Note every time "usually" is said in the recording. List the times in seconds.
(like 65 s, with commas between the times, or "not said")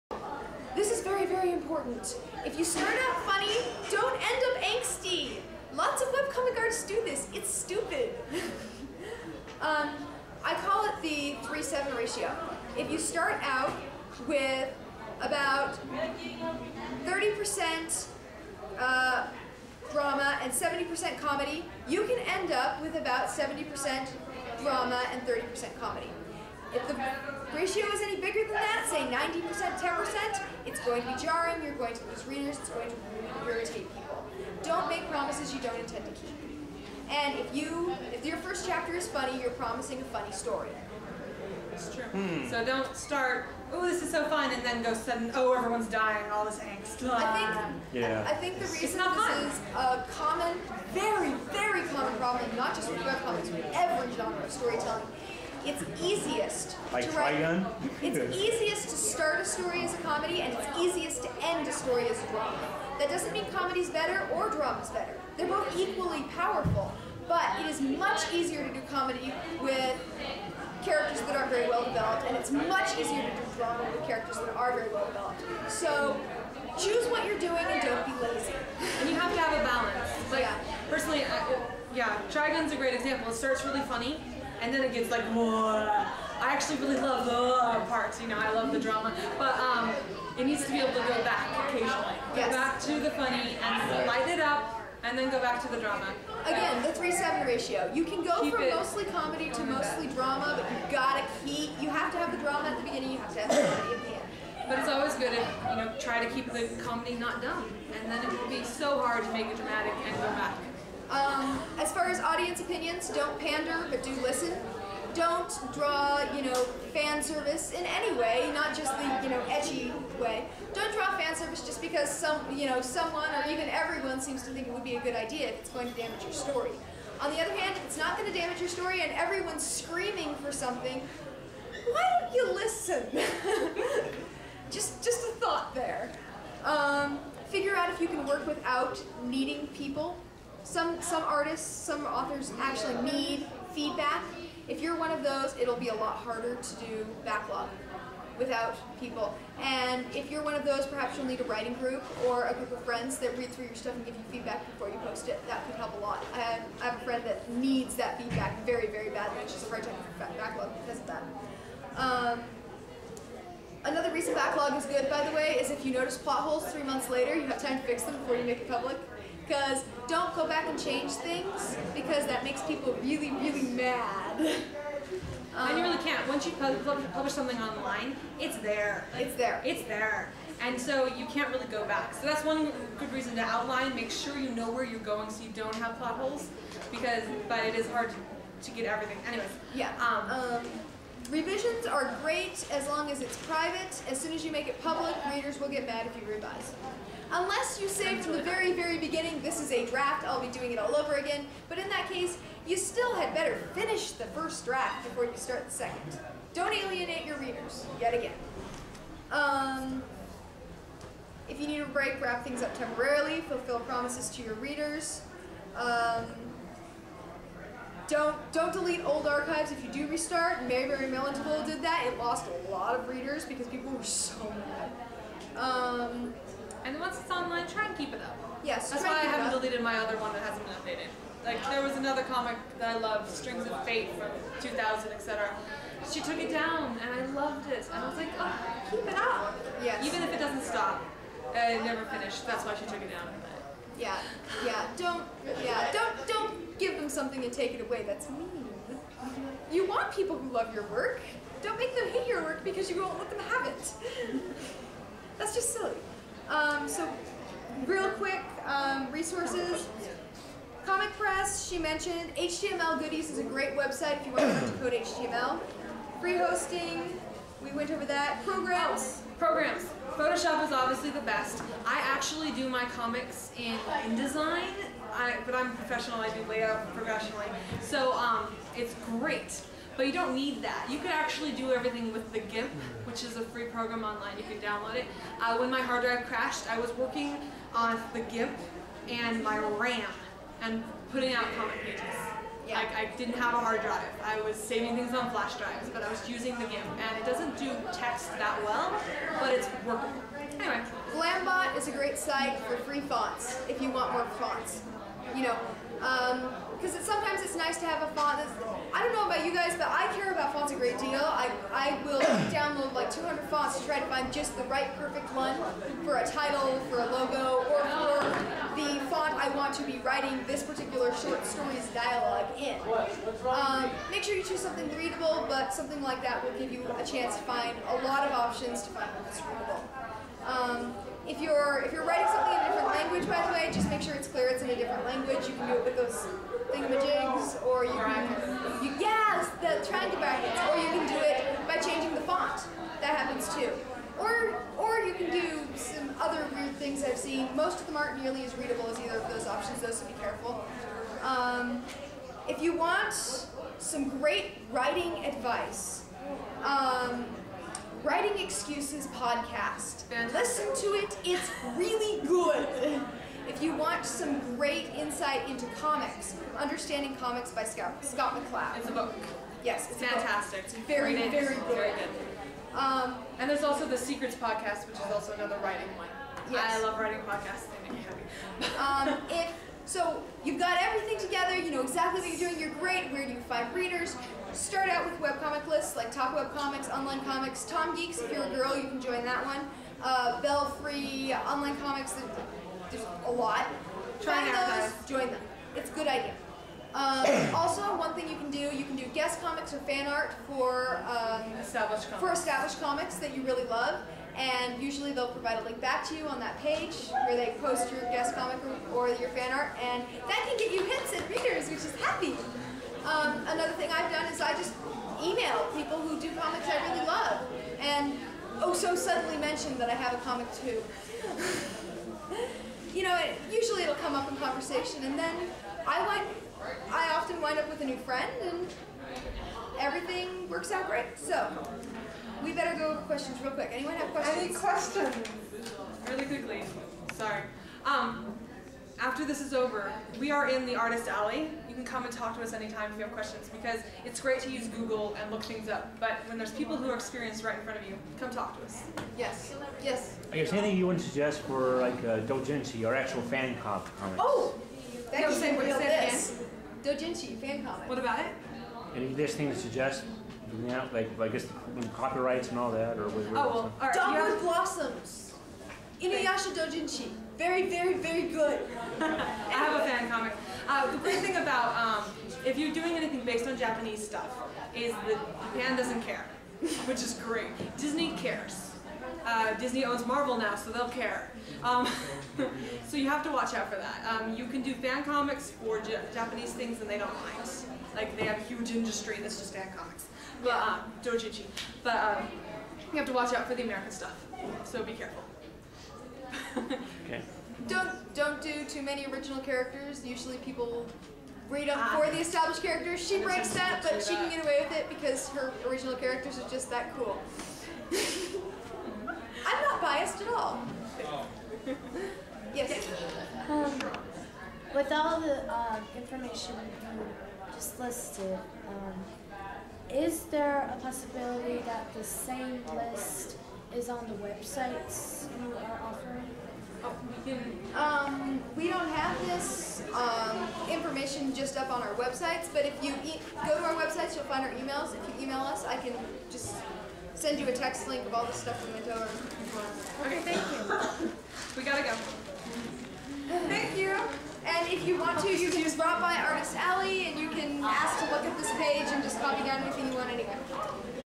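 404 s, 423 s, 500 s.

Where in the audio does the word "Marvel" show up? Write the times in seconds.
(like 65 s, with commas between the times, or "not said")
480 s.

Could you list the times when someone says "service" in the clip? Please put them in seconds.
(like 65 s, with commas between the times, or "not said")
117 s, 121 s.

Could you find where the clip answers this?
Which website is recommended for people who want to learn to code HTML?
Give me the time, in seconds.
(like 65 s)
262 s.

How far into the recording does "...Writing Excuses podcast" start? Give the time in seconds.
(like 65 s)
358 s.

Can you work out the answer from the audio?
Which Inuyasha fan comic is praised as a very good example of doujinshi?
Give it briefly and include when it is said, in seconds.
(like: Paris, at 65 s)
Dogwood Blossoms, at 463 s.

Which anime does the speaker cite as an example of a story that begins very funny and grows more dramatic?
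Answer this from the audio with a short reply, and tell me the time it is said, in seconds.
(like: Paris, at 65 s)
Trigun, at 82 s.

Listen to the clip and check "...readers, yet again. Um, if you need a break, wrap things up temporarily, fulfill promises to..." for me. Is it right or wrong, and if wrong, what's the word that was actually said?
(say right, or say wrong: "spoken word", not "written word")
right.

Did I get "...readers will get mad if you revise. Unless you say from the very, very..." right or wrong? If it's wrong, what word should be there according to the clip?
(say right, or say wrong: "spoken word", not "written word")
right.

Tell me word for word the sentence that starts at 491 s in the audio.
But um, you have to watch out for the American stuff.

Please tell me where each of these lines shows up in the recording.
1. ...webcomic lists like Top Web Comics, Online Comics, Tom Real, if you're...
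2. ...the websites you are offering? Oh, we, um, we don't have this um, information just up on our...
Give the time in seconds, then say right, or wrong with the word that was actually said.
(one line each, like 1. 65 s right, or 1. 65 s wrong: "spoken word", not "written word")
1. 385 s wrong: "Geeks", not "Real"
2. 524 s right.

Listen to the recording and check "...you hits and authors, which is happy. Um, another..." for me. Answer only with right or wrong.
wrong.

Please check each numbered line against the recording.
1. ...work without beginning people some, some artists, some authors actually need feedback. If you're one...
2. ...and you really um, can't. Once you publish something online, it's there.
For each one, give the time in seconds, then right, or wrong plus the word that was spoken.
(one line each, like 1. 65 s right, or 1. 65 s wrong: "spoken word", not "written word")
1. 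138 s wrong: "needing", not "beginning"
2. 175 s right.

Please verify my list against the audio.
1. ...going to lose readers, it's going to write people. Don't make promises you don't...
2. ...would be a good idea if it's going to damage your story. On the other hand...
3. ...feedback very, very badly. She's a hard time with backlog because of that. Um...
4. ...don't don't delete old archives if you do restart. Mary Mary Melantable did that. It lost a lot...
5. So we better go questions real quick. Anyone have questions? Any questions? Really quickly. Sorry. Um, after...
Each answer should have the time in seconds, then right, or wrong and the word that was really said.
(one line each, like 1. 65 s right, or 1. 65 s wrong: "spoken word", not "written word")
1. 31 s wrong: "irritate", not "write"
2. 124 s right
3. 158 s right
4. 218 s right
5. 431 s right.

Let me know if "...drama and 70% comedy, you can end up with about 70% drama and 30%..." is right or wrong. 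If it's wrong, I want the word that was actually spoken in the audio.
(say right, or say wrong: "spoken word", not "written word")
right.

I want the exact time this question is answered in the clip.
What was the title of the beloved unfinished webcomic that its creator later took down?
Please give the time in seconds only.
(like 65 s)
233 s.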